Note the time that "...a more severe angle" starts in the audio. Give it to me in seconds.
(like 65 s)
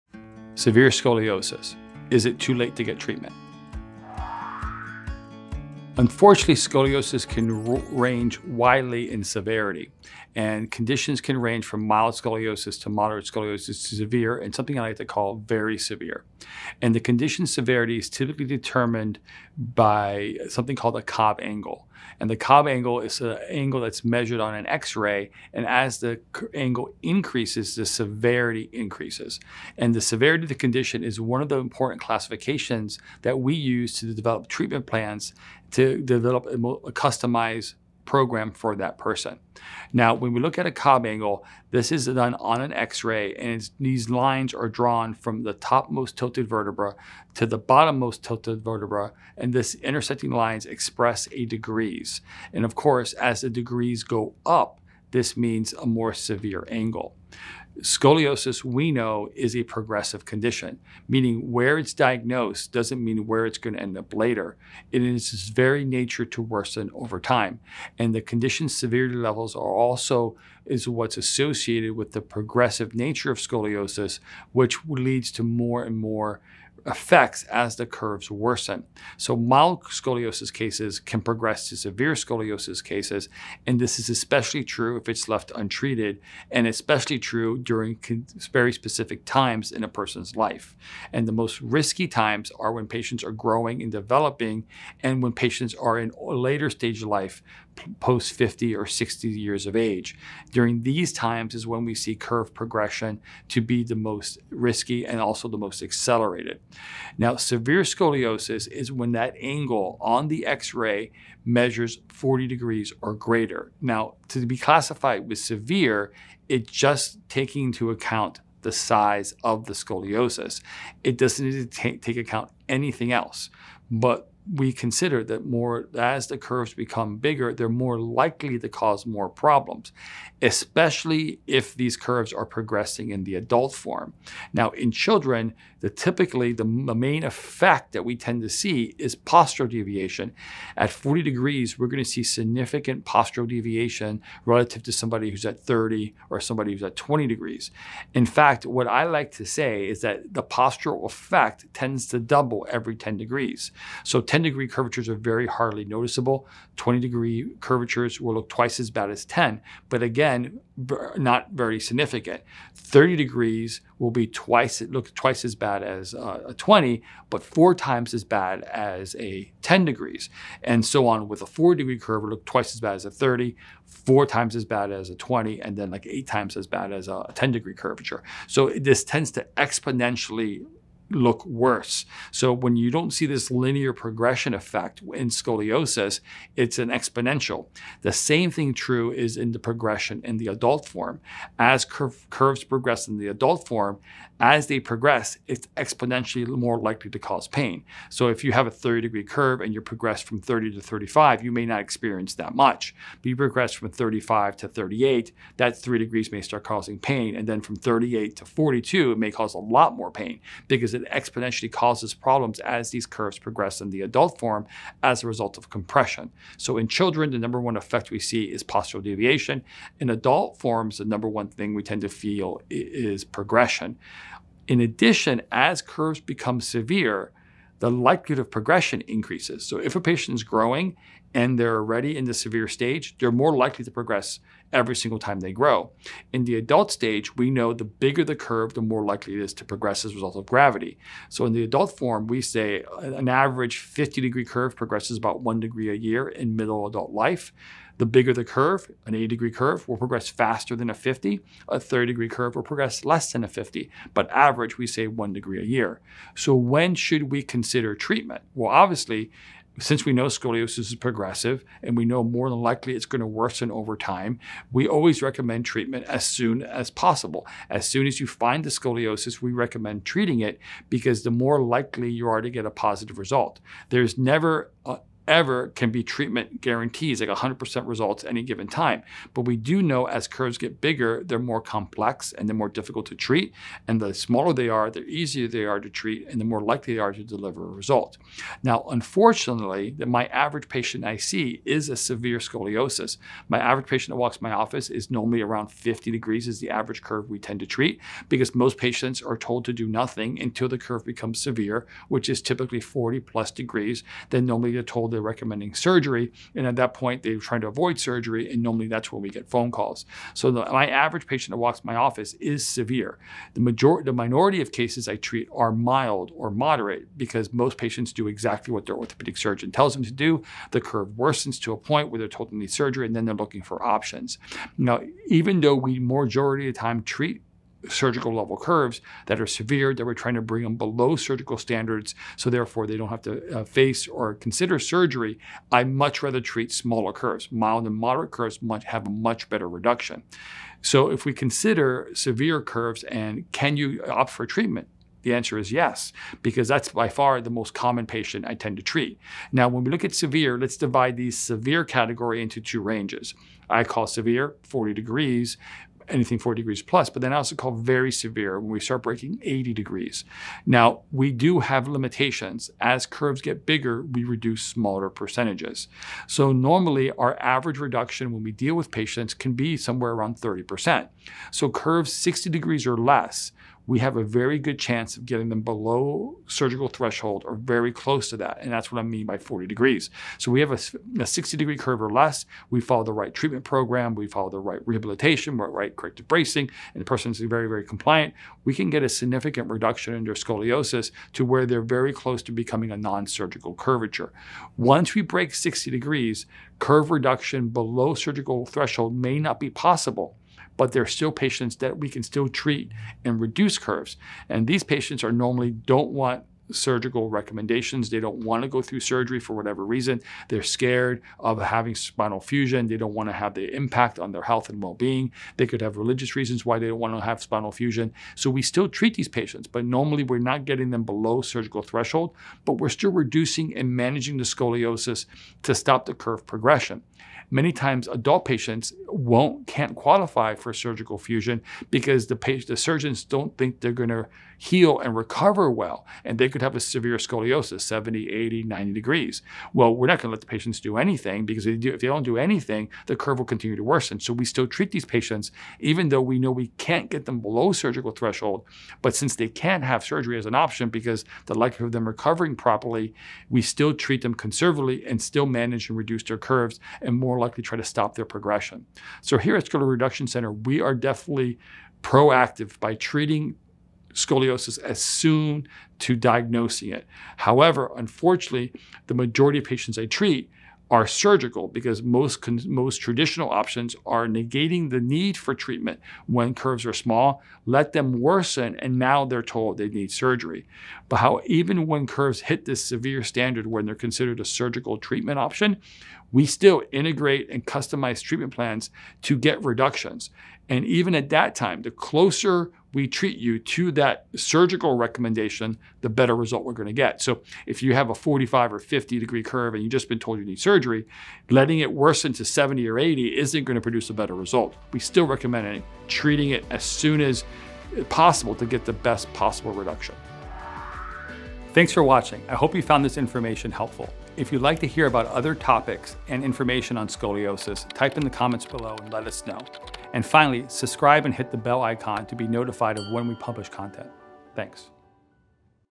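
55 s.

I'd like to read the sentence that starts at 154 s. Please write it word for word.
So 10 10 degree curvatures are very hardly noticeable.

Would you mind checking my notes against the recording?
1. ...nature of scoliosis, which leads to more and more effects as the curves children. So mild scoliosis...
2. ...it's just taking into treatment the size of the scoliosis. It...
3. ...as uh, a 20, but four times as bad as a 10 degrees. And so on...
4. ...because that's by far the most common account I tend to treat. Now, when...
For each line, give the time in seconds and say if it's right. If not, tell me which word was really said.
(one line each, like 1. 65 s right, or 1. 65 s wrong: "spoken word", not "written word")
1. 72 s wrong: "worsen", not "children"
2. 116 s wrong: "account", not "treatment"
3. 165 s right
4. 346 s wrong: "patient", not "account".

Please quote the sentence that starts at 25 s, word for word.
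And as the angle increases, the severity increases.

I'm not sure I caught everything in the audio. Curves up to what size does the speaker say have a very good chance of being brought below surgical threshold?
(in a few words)
60 degrees or less.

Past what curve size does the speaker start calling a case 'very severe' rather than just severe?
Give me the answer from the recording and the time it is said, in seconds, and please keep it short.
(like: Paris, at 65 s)
80 degrees, at 359 s.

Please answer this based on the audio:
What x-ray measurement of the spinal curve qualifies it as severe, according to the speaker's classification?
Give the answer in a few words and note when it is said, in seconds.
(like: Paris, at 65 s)
40 degrees or greater, at 112 s.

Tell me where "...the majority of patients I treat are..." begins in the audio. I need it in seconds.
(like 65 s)
469 s.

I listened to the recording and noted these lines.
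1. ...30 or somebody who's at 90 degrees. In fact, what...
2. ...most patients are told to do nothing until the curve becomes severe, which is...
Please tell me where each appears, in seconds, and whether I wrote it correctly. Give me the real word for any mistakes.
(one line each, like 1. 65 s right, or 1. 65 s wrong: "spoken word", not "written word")
1. 145 s wrong: "20", not "90"
2. 298 s right.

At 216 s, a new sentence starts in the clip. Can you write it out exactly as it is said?
So in children, the number one effect we see is postural deviation.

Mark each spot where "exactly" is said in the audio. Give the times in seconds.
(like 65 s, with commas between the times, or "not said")
318 s.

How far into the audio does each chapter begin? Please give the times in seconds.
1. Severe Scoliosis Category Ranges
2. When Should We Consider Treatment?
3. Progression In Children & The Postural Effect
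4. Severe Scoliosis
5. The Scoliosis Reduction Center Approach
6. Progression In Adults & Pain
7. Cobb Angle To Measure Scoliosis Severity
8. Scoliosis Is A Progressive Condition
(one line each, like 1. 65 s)
1. 349 s
2. 255 s
3. 150 s
4. 108 s
5. 459 s
6. 190 s
7. 21 s
8. 62 s.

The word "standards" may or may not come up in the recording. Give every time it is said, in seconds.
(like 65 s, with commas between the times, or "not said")
331 s, 483 s.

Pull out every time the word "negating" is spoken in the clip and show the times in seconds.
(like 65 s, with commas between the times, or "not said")
474 s.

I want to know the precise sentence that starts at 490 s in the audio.
And even at that time, the closer we treat you to that surgical recommendation, the better result we're going to get.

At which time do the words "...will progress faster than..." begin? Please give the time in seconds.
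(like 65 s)
249 s.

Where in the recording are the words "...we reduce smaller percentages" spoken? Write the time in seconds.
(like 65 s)
364 s.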